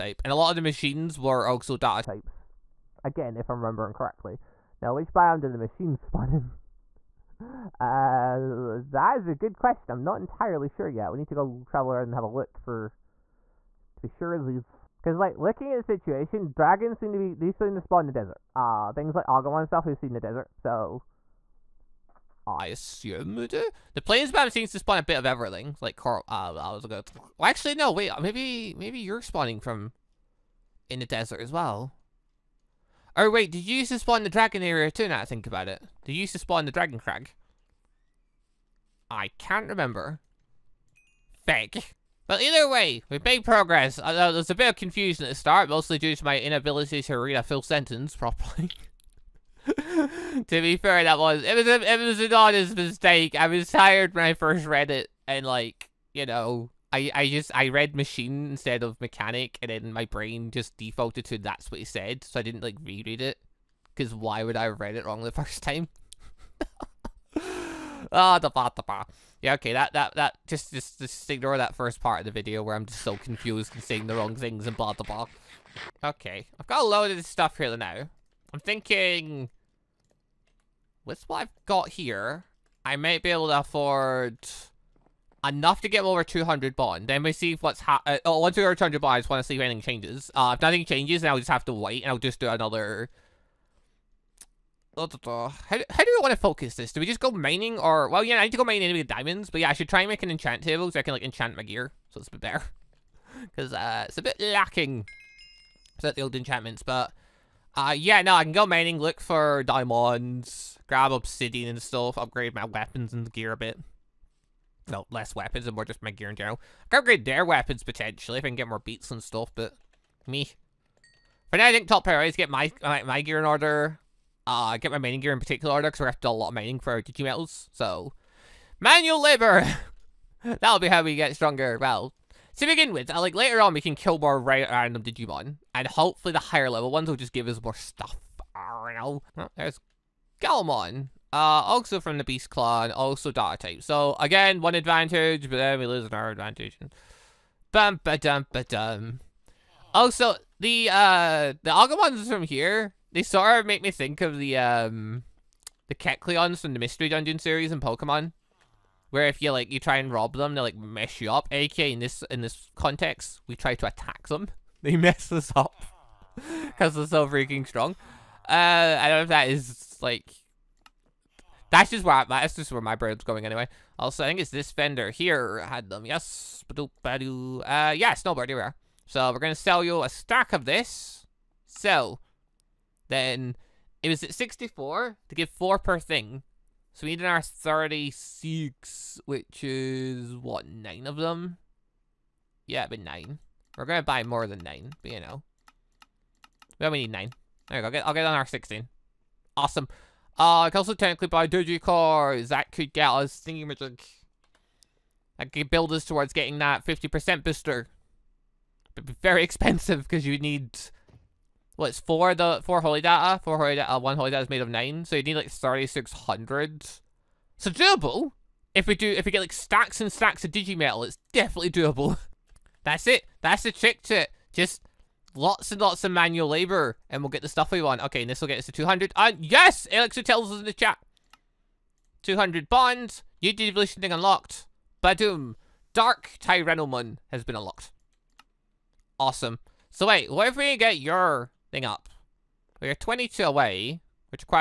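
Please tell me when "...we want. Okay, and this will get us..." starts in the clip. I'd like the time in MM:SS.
03:47.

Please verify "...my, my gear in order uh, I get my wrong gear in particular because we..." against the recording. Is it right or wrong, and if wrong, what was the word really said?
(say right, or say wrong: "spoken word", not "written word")
wrong: "mining", not "wrong".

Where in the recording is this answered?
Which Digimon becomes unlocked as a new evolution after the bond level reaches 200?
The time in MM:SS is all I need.
03:55.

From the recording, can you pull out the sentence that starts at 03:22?
That could get us thinking magic.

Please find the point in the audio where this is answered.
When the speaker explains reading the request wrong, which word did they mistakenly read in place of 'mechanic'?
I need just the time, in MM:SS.
00:57.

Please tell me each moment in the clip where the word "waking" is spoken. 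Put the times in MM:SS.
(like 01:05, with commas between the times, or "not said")
not said.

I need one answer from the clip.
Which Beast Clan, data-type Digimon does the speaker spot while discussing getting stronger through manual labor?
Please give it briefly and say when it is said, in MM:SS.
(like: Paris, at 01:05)
Galmon, at 02:20.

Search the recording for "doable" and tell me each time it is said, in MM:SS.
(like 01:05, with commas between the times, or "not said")
03:37, 03:41.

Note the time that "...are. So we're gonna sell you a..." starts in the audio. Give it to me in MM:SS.
02:58.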